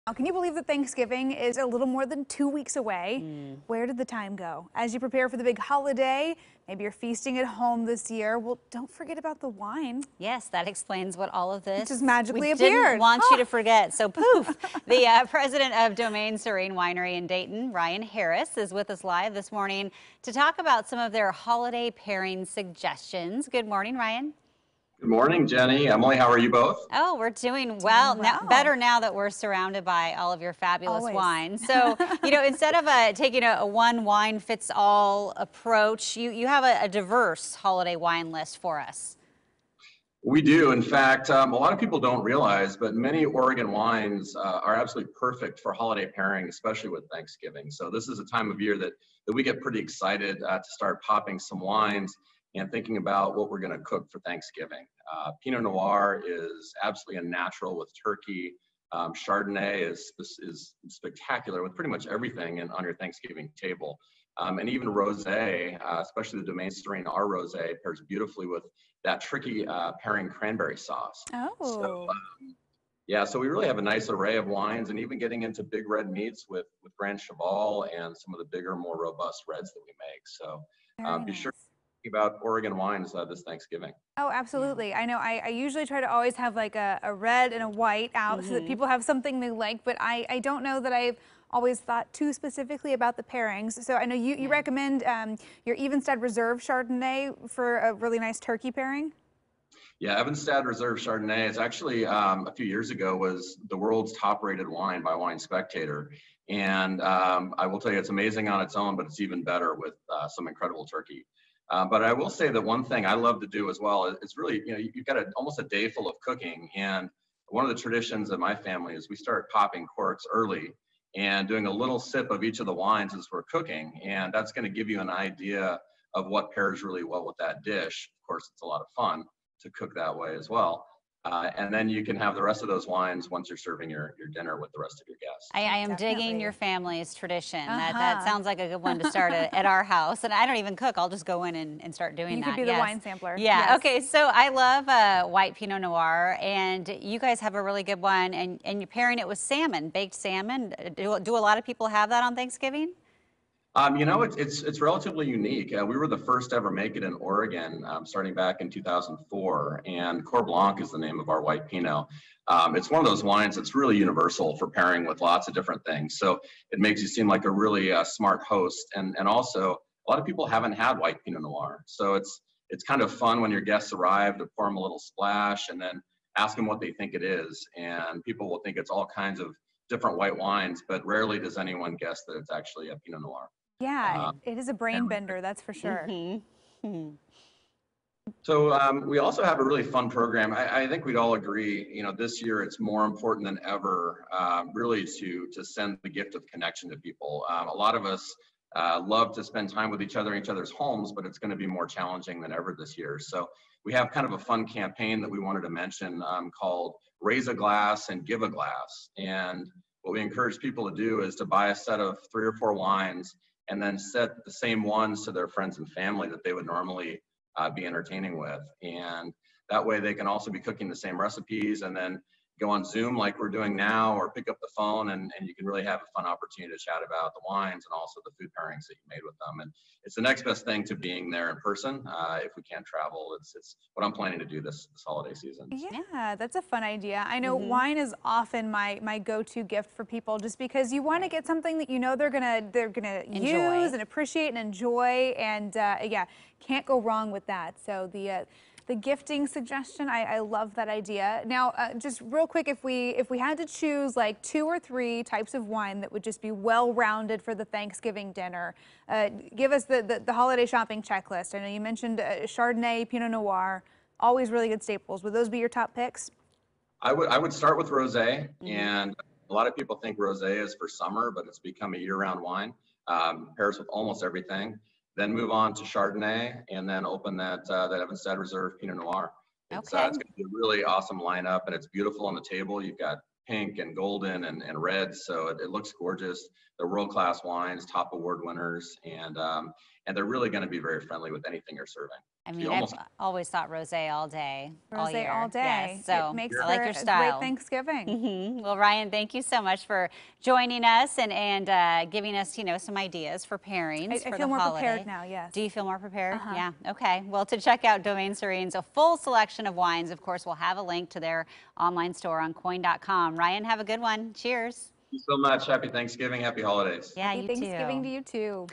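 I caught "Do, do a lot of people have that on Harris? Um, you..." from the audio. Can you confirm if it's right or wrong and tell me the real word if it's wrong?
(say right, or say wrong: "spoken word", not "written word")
wrong: "Thanksgiving", not "Harris".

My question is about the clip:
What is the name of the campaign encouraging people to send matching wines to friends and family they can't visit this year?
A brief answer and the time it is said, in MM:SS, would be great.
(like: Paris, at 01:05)
Raise a Glass and Give a Glass, at 03:27.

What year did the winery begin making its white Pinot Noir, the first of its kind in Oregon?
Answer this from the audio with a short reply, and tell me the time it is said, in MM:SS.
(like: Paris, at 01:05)
2004, at 02:38.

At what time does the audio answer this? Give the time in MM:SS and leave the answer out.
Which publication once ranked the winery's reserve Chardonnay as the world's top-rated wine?
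01:45.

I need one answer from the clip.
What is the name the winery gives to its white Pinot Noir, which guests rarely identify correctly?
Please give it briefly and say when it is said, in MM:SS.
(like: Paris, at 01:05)
Coeur Blanc, at 02:40.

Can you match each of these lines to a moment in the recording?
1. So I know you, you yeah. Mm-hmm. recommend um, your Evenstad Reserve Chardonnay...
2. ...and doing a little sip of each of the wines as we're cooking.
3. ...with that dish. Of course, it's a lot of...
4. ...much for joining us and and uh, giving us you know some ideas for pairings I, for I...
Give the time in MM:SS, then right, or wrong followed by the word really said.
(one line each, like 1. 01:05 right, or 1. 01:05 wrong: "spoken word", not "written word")
1. 01:33 right
2. 02:01 right
3. 02:07 right
4. 04:59 right.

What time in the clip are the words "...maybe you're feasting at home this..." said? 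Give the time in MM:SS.
00:06.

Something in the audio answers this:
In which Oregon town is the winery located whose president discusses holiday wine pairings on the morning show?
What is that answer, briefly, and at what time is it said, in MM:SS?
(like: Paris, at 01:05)
Dayton, at 00:17.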